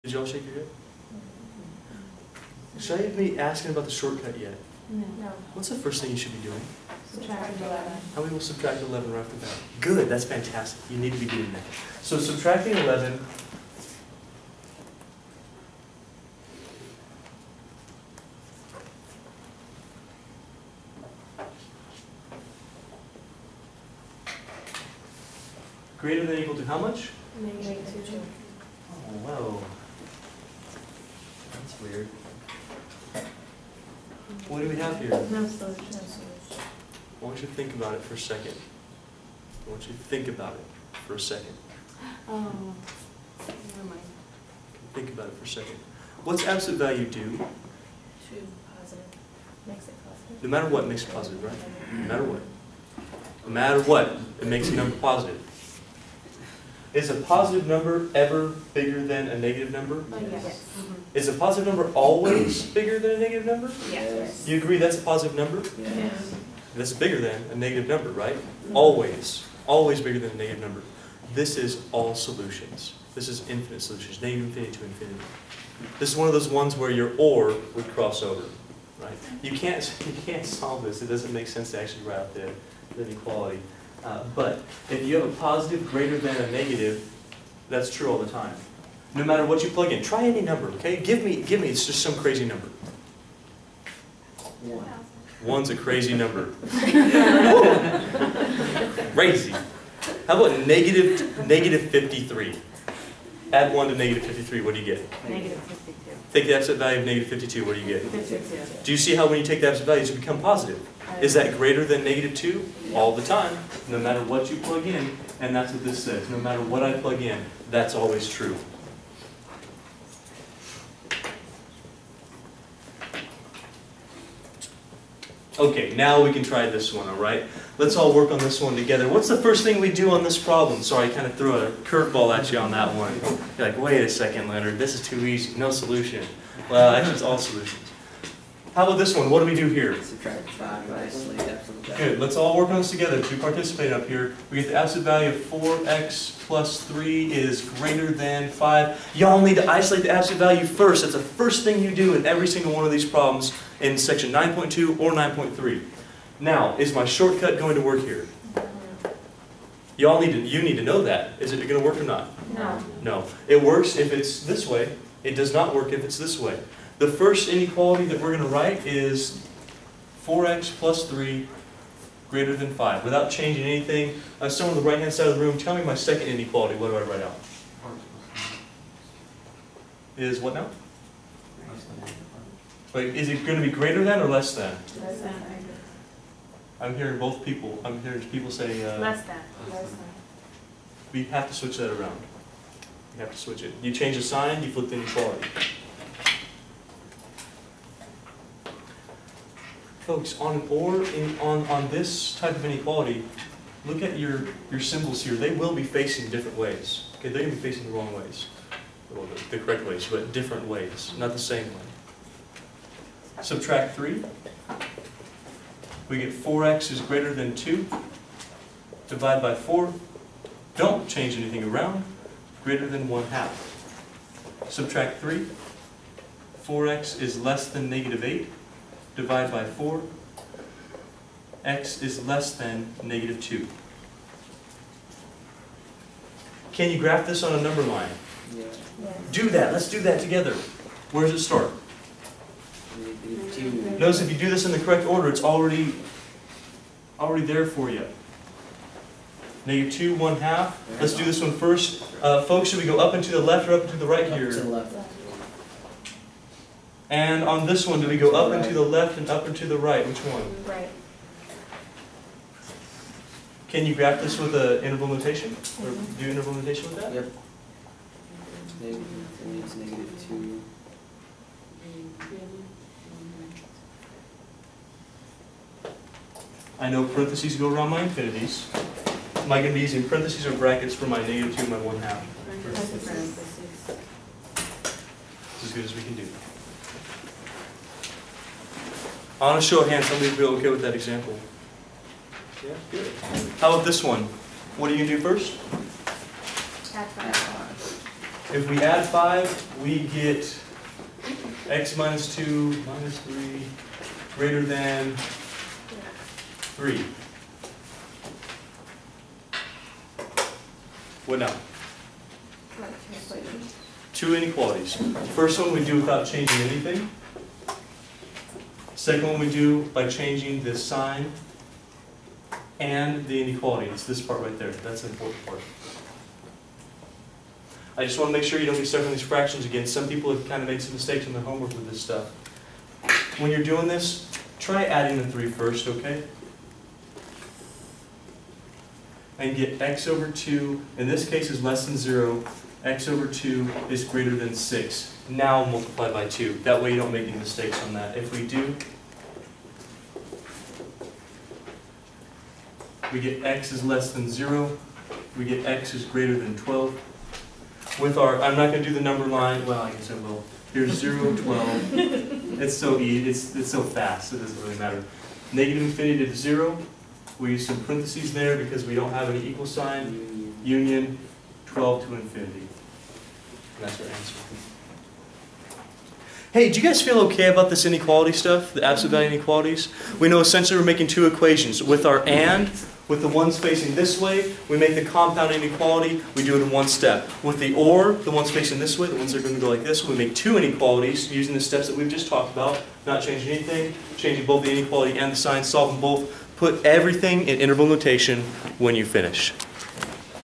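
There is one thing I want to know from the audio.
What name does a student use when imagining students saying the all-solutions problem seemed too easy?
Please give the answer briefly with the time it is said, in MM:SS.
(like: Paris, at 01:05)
Leonard, at 02:14.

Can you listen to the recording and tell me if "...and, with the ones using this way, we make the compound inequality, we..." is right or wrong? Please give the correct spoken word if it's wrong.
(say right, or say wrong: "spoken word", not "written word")
wrong: "facing", not "using".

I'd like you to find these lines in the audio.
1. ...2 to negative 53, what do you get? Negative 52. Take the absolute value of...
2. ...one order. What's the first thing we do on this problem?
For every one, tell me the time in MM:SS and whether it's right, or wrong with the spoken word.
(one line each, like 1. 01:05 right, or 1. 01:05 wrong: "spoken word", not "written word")
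1. 01:43 wrong: "1", not "2"
2. 02:08 wrong: "together", not "order".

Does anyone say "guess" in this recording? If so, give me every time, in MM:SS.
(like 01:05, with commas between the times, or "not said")
05:59.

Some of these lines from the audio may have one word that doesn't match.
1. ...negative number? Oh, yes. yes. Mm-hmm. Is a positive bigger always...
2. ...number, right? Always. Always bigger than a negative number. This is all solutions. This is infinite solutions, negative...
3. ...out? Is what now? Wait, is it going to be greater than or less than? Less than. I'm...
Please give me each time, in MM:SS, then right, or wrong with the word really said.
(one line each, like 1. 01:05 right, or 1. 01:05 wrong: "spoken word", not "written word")
1. 00:59 wrong: "number", not "bigger"
2. 01:07 right
3. 02:57 right.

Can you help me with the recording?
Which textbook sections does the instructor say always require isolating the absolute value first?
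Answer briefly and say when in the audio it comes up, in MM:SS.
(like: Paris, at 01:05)
9.2 or 9.3, at 02:33.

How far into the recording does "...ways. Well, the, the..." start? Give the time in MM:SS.
03:28.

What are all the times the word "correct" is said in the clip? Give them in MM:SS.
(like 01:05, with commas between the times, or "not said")
03:29, 04:04.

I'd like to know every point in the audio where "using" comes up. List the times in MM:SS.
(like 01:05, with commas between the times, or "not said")
04:39, 06:31.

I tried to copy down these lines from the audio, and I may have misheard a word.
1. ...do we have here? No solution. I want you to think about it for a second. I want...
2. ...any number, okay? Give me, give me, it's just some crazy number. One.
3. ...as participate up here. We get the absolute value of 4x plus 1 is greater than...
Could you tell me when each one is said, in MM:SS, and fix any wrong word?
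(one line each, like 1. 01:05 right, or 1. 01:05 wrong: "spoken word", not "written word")
1. 00:34 right
2. 01:30 right
3. 02:23 wrong: "3", not "1".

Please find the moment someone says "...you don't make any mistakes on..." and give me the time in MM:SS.
05:46.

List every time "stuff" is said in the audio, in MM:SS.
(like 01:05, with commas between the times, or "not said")
05:31, 06:18.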